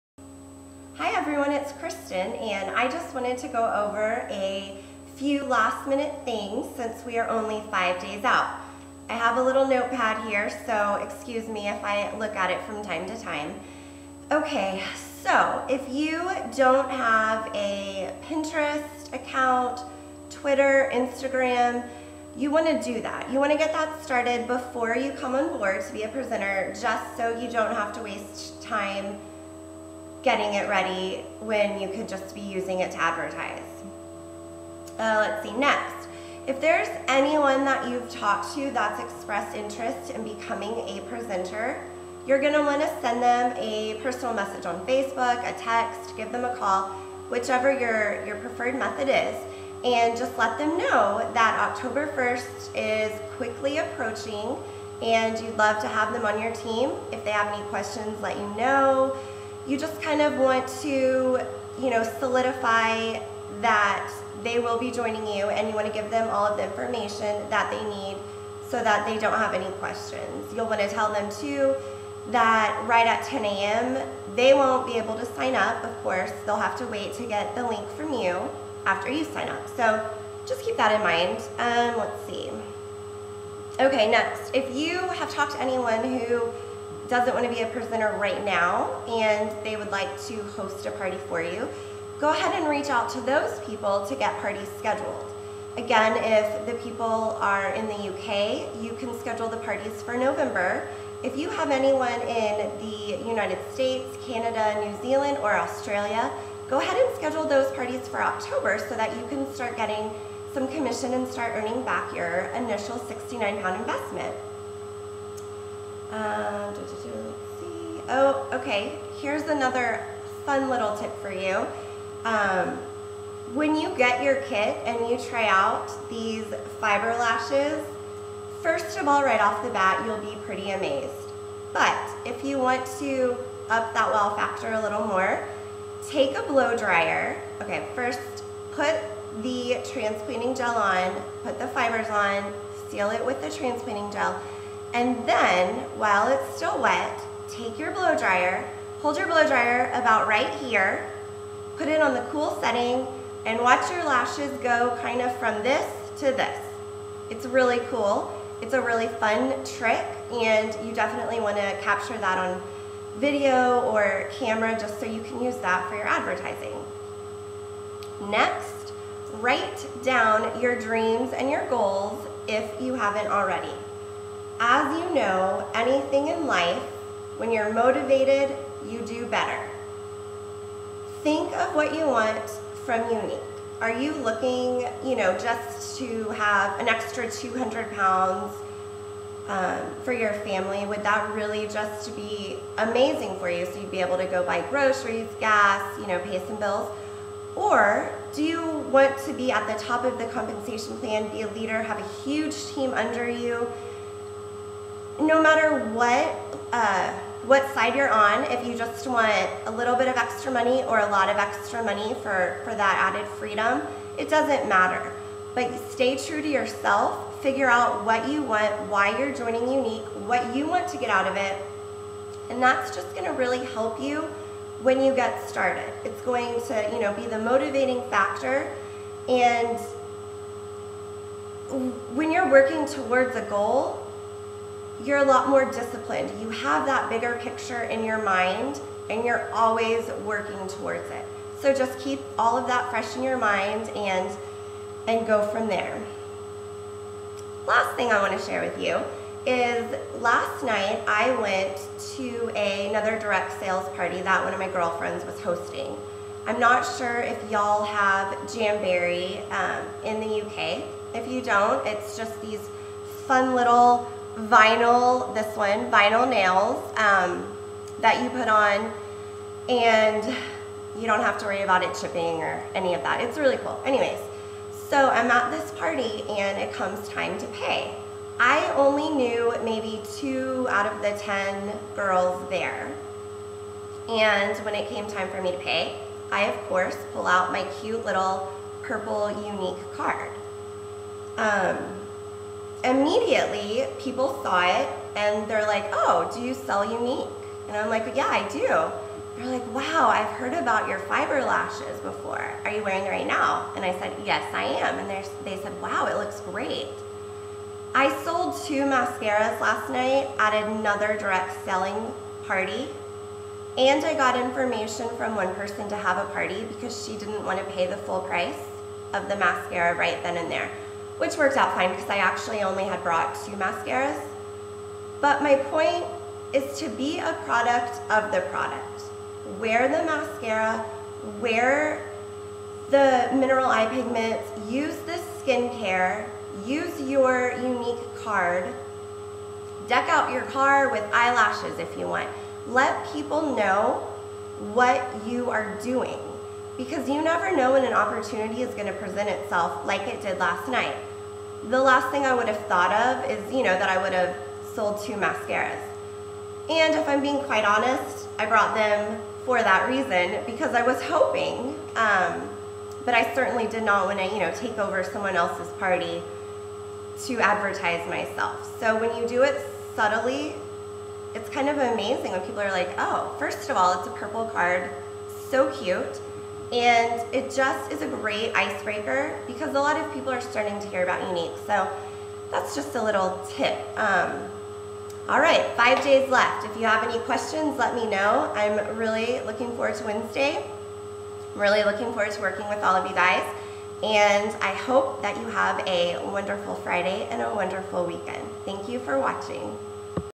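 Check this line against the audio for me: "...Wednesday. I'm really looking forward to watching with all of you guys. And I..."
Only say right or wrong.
wrong.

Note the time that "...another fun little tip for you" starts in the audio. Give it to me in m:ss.
1:59.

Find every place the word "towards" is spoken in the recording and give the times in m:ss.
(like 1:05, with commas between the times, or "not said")
3:52, 4:00.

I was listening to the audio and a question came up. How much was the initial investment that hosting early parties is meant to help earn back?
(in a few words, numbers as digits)
69 pounds.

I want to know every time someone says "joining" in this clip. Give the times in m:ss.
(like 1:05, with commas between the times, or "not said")
1:04, 3:39.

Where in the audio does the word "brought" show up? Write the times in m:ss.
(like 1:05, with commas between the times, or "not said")
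5:23, 5:58.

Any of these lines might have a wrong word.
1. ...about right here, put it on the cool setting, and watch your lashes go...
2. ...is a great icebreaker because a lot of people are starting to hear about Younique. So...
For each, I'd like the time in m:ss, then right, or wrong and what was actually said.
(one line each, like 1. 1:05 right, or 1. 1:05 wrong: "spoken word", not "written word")
1. 2:29 right
2. 6:17 right.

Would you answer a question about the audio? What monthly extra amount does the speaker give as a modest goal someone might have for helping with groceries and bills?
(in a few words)
200 pounds.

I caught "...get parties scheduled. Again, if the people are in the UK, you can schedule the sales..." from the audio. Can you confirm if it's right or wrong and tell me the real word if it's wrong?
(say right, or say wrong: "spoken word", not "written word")
wrong: "parties", not "sales".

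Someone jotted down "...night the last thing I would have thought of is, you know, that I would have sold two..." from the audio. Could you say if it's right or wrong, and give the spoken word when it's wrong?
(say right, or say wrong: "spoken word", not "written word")
right.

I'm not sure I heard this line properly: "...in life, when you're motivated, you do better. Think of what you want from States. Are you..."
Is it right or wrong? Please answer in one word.
wrong.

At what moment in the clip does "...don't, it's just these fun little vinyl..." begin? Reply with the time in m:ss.
4:21.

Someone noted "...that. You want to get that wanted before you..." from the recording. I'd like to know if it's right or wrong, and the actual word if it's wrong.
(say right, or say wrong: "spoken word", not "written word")
wrong: "started", not "wanted".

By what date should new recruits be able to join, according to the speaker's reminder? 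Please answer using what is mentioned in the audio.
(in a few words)
October 1st.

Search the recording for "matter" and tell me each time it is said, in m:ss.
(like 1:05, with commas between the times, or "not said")
3:25, 3:34.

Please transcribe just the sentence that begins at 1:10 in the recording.
You'll want to tell them too that right at 10 a.m.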